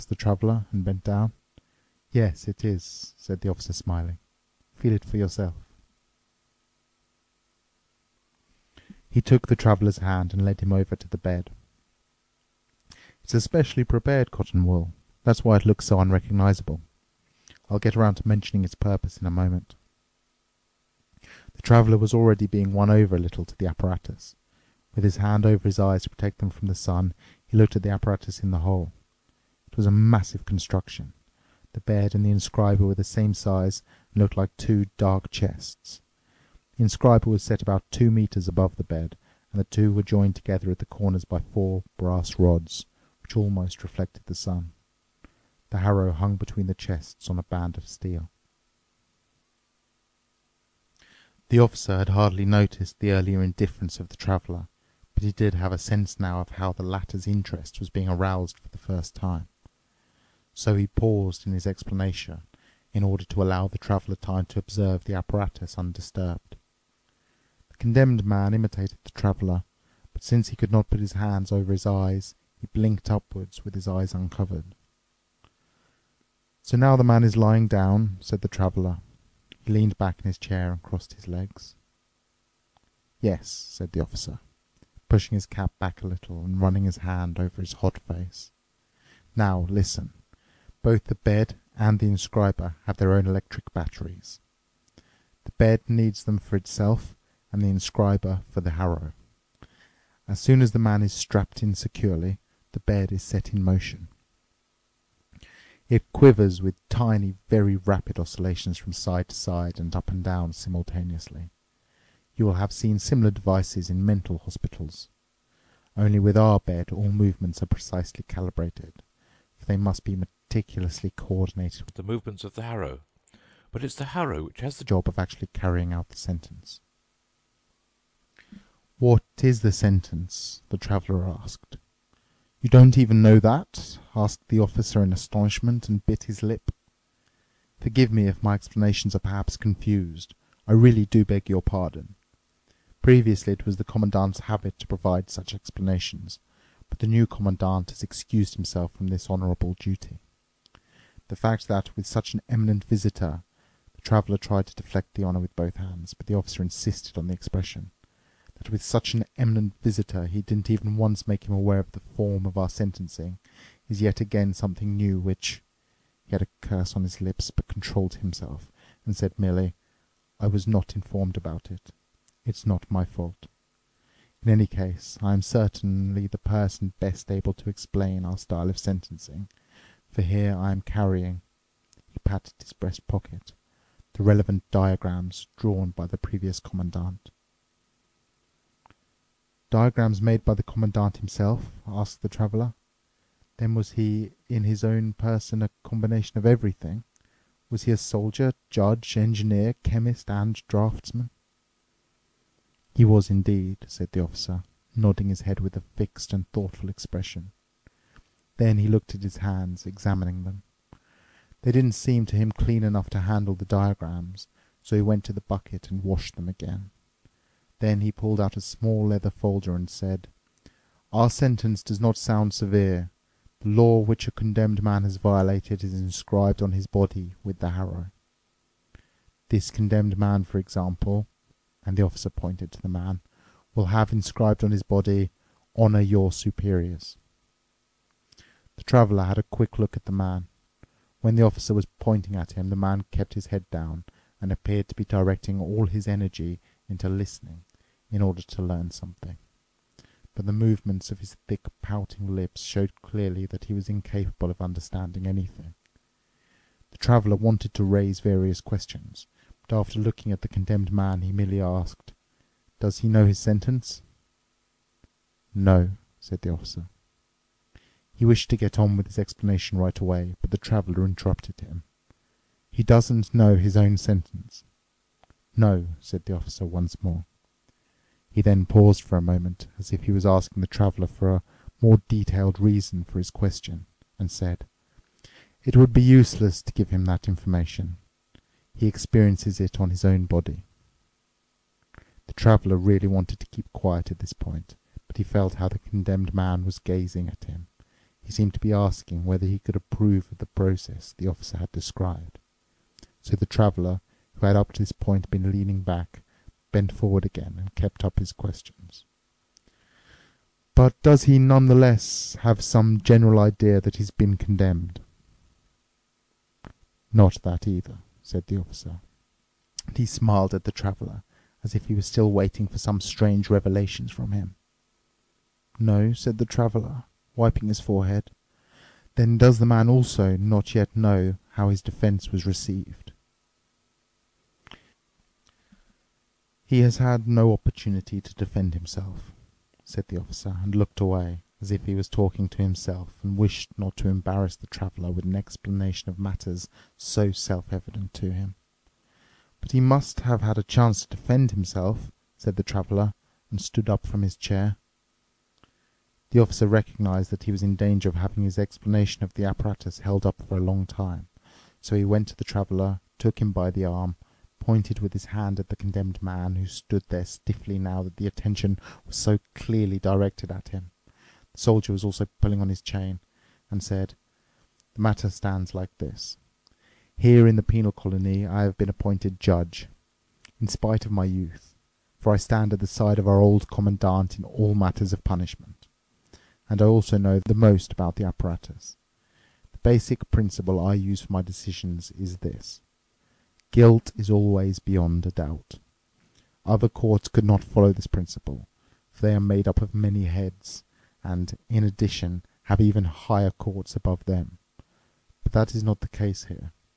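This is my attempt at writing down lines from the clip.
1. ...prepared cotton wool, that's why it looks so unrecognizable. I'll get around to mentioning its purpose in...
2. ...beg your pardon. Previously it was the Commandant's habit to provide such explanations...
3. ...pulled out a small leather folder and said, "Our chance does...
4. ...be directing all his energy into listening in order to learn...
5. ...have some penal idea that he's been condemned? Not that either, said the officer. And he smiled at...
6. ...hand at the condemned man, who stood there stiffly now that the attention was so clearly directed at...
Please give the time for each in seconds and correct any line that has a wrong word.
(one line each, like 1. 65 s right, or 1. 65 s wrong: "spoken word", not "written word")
1. 13 s right
2. 141 s right
3. 218 s wrong: "sentence", not "chance"
4. 244 s right
5. 312 s wrong: "general", not "penal"
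6. 365 s right.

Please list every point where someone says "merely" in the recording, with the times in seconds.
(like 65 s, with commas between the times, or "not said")
169 s, 261 s.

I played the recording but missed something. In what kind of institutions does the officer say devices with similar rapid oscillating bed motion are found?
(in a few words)
mental hospitals.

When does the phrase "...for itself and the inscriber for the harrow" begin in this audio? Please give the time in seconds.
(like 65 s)
96 s.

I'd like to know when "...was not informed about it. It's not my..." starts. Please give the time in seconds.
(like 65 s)
170 s.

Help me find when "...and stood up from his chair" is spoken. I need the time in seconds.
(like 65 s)
353 s.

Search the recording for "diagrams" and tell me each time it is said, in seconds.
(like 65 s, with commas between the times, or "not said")
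184 s, 189 s, 213 s.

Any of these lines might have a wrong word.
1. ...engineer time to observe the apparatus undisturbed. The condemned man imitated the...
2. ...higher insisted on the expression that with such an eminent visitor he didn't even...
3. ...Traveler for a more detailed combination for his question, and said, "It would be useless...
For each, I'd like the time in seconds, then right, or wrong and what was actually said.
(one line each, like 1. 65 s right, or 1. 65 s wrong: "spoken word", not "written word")
1. 63 s wrong: "traveler", not "engineer"
2. 156 s wrong: "officer", not "higher"
3. 280 s wrong: "reason", not "combination".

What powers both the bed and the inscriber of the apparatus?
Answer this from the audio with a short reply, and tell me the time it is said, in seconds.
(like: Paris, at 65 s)
electric batteries, at 93 s.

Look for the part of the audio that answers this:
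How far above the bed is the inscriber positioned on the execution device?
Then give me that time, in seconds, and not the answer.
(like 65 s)
37 s.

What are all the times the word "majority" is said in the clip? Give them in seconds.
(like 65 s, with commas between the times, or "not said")
not said.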